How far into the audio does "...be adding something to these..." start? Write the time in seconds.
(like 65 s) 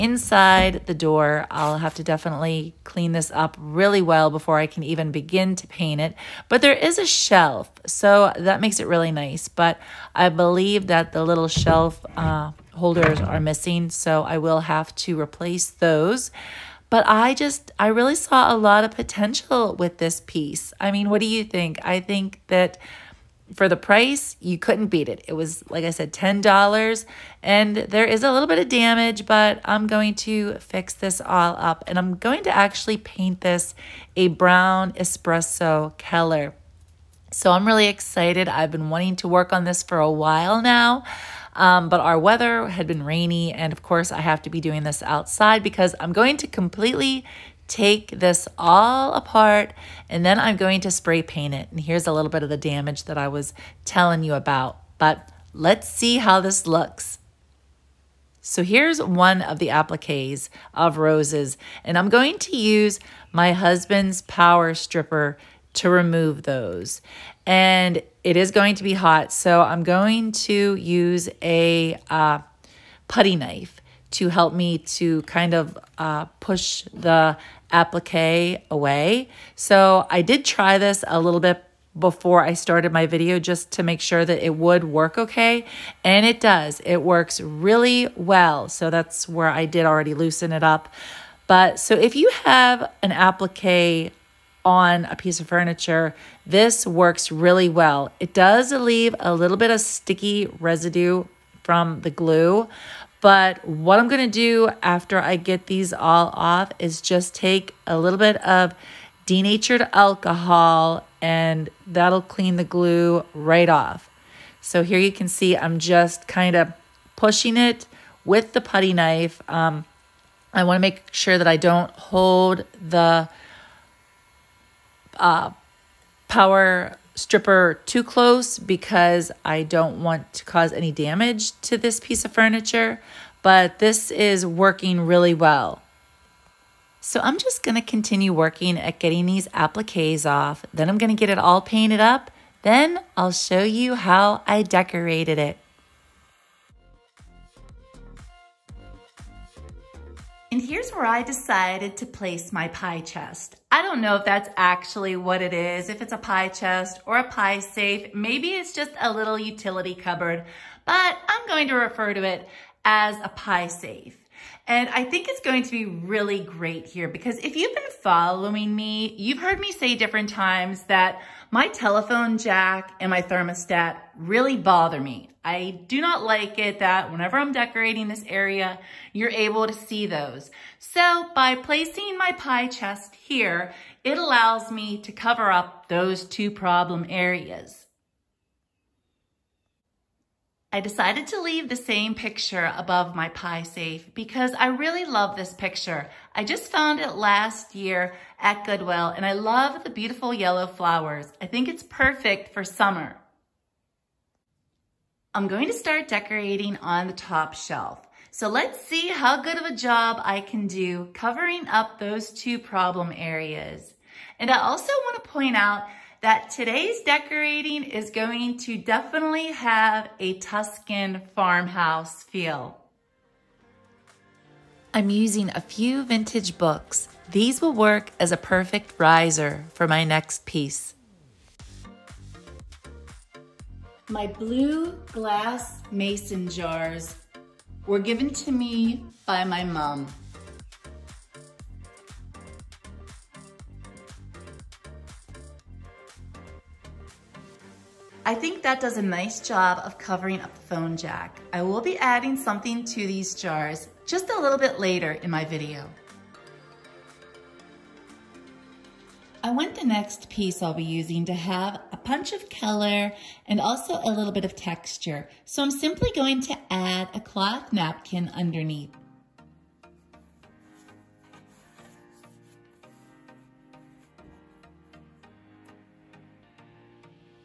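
251 s.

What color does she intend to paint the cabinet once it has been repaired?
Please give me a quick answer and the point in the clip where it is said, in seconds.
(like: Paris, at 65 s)
brown espresso, at 34 s.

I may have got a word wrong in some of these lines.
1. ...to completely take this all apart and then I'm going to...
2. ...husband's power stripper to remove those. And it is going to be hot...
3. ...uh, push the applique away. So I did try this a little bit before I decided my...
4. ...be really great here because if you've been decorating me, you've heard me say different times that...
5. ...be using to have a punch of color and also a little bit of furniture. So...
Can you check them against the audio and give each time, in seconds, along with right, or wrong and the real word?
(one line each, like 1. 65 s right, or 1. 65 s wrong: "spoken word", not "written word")
1. 46 s right
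2. 63 s right
3. 75 s wrong: "started", not "decided"
4. 165 s wrong: "following", not "decorating"
5. 260 s wrong: "texture", not "furniture".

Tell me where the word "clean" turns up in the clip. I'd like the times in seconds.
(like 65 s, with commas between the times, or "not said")
2 s, 112 s.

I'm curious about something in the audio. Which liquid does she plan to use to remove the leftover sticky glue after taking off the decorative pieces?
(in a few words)
denatured alcohol.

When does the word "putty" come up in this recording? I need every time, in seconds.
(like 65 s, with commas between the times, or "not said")
73 s, 118 s.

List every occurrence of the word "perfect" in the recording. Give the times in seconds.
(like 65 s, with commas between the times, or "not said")
201 s, 228 s.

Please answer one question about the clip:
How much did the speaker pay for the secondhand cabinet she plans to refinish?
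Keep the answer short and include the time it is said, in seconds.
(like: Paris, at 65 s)
$10, at 26 s.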